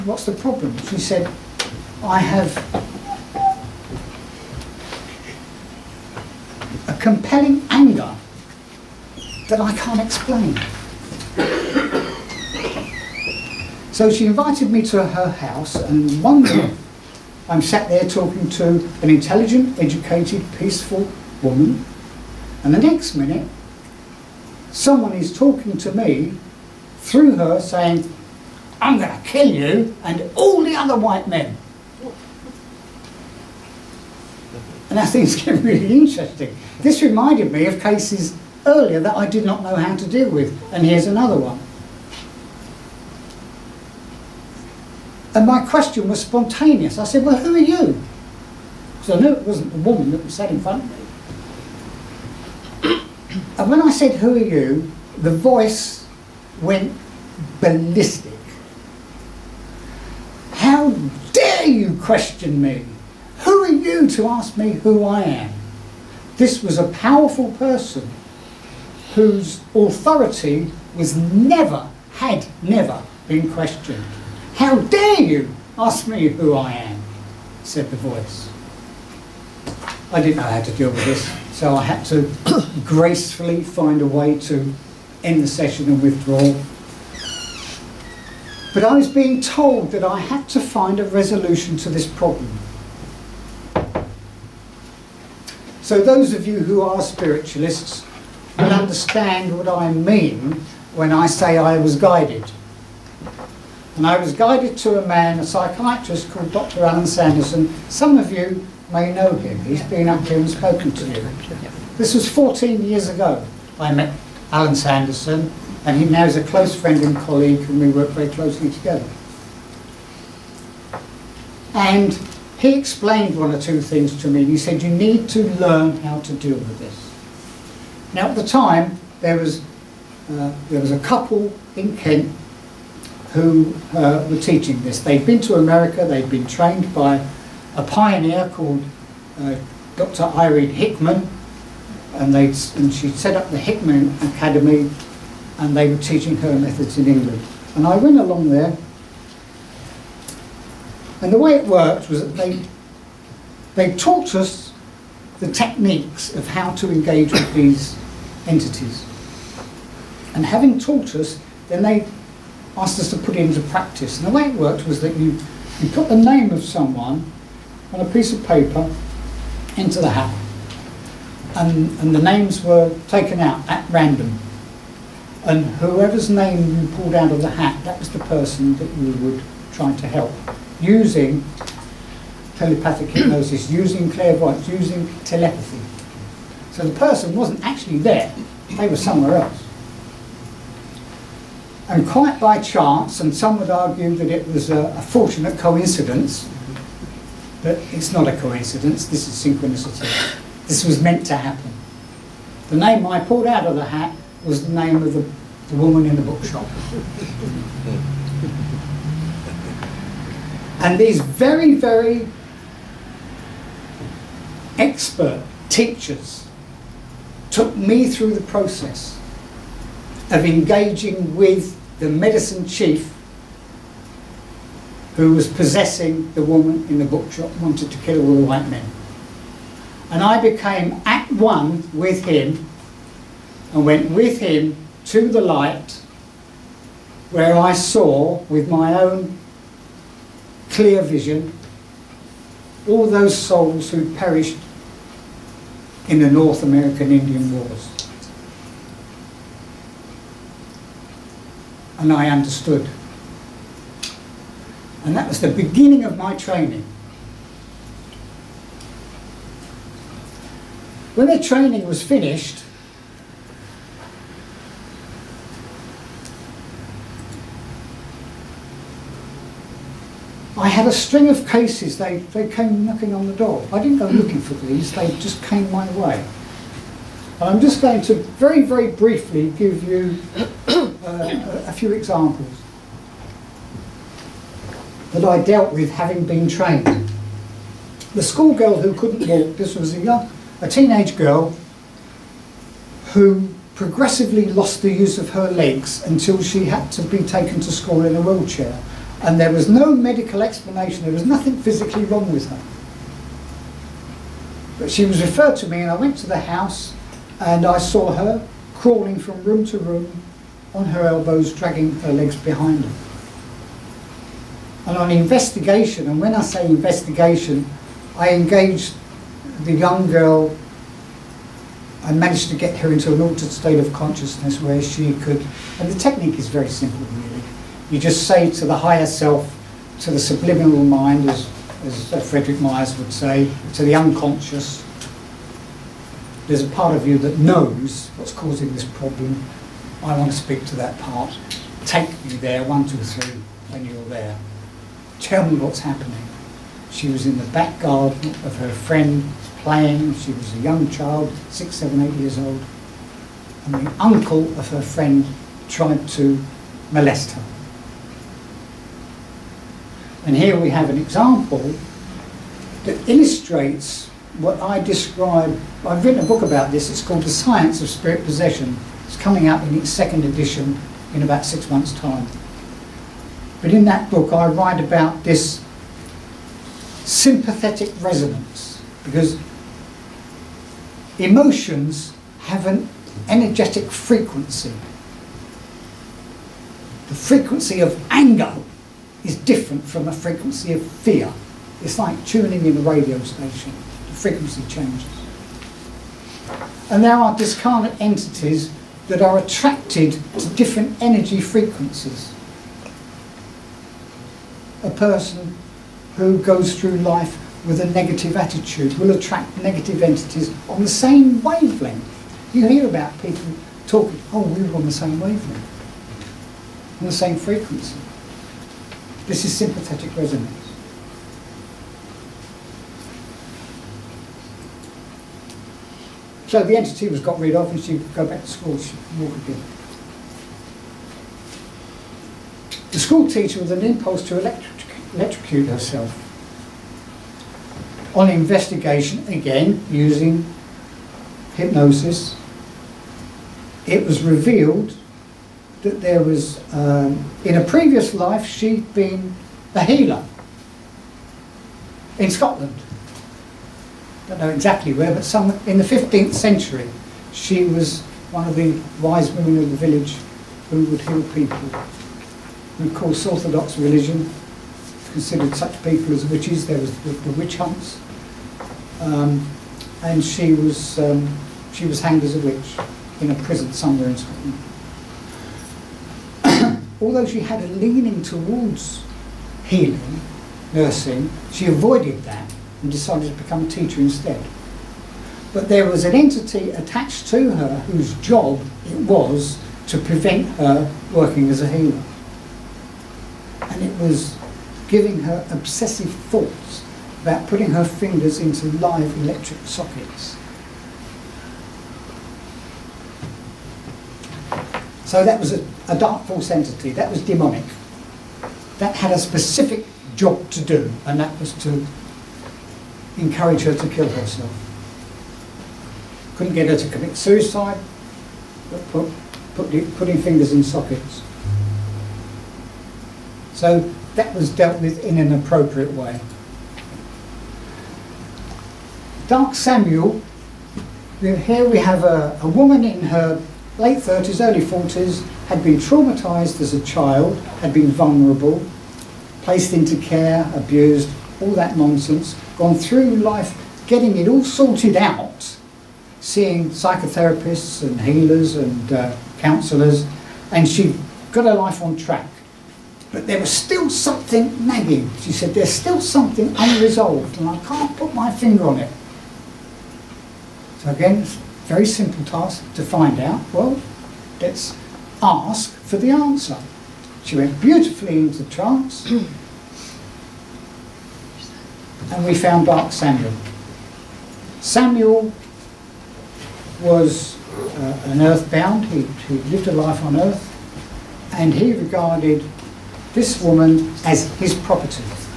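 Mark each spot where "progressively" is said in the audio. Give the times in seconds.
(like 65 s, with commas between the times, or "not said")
293 s.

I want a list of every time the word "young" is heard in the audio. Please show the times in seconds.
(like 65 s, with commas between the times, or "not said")
289 s, 319 s, 350 s.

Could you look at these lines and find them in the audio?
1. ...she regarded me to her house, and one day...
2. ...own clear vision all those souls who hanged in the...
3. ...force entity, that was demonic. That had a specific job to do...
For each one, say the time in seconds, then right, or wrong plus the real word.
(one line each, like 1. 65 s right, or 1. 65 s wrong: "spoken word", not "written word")
1. 14 s wrong: "invited", not "regarded"
2. 238 s wrong: "perished", not "hanged"
3. 506 s right.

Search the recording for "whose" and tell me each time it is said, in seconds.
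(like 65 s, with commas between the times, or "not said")
69 s, 487 s.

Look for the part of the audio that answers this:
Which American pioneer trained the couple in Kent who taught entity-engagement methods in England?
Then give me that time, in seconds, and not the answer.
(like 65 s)
139 s.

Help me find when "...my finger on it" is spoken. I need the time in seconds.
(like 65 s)
558 s.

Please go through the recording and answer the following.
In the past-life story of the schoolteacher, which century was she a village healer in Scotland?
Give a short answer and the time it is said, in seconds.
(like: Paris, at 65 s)
15th century, at 455 s.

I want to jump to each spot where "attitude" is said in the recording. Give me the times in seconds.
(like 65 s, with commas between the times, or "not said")
408 s.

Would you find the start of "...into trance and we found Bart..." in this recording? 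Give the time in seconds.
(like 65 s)
568 s.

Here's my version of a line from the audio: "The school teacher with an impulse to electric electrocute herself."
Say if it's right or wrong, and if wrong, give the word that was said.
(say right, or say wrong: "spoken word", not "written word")
right.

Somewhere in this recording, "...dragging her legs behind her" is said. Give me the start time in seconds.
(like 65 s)
311 s.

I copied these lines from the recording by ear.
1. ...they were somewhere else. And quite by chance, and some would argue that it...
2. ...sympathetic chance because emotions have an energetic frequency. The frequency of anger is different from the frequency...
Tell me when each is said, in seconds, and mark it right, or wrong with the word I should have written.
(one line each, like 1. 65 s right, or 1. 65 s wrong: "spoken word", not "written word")
1. 188 s right
2. 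377 s wrong: "resonance", not "chance".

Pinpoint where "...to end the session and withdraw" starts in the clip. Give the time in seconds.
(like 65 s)
84 s.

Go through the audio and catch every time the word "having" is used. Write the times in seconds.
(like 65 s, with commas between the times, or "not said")
160 s, 285 s.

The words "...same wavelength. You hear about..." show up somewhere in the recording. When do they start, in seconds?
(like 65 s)
410 s.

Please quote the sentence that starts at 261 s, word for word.
When the training was finished, I had a string of cases, they, they came knocking on the door.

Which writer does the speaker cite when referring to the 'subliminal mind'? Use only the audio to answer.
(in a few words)
Frederick Myers.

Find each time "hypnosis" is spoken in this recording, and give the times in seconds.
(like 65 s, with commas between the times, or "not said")
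183 s, 441 s.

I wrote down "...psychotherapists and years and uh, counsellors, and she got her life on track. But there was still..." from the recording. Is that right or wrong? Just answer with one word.
wrong.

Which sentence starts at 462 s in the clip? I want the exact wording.
And of course, Orthodox religion considered such people as witches.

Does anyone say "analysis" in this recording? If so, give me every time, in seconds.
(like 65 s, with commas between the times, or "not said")
not said.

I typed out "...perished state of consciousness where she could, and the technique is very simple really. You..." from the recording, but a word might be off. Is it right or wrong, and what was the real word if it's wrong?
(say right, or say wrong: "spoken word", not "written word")
wrong: "altered", not "perished".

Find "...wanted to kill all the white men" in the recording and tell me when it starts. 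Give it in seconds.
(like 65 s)
227 s.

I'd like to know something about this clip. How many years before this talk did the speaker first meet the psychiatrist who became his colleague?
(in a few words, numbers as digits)
14.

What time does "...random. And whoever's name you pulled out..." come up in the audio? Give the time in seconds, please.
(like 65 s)
173 s.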